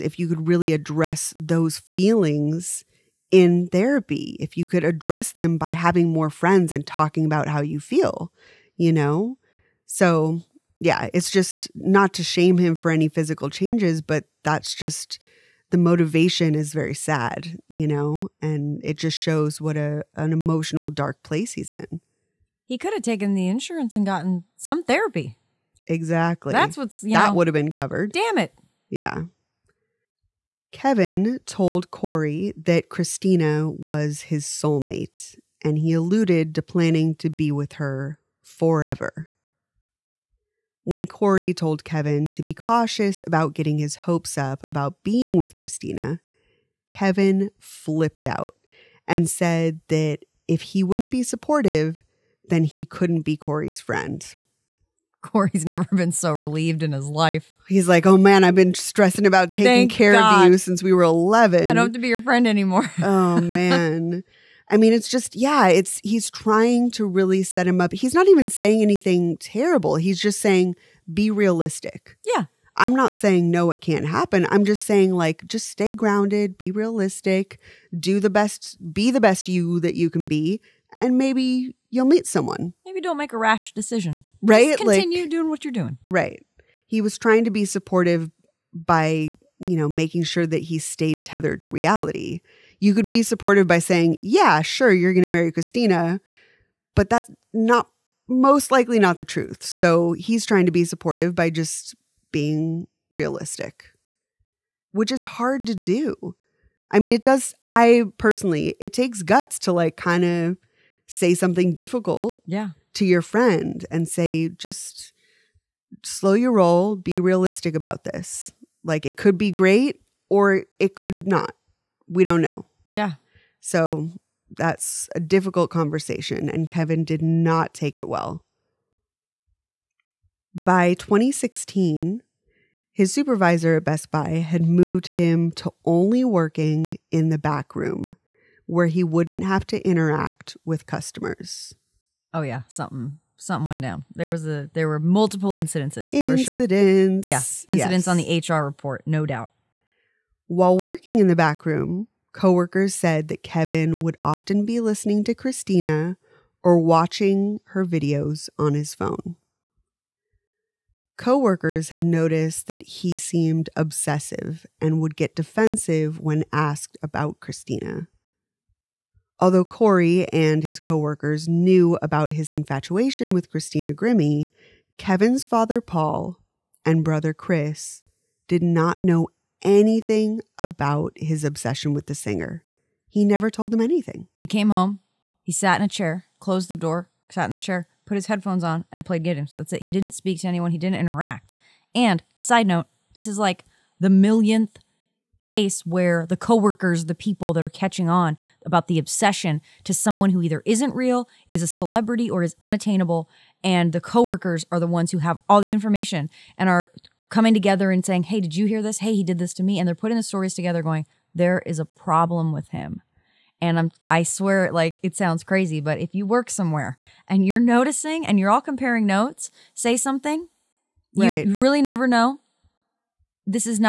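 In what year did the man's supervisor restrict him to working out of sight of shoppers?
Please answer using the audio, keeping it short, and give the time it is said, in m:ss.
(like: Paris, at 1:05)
2016, at 2:10.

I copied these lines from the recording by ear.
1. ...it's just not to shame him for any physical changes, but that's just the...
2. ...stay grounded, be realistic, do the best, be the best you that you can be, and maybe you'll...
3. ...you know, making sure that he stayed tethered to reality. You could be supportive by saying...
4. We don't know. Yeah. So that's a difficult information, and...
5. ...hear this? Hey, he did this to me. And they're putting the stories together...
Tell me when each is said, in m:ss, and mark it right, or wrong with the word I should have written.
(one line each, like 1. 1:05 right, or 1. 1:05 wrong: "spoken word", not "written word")
1. 0:11 right
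2. 1:15 right
3. 1:29 right
4. 2:02 wrong: "conversation", not "information"
5. 3:28 right.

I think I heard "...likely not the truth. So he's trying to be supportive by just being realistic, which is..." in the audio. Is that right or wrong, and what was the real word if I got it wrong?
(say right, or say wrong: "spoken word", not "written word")
right.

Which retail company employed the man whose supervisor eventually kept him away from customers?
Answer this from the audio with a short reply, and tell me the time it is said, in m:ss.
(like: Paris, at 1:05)
Best Buy, at 2:13.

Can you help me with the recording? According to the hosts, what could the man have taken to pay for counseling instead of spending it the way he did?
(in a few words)
The insurance.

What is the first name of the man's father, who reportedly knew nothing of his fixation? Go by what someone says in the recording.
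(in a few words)
Paul.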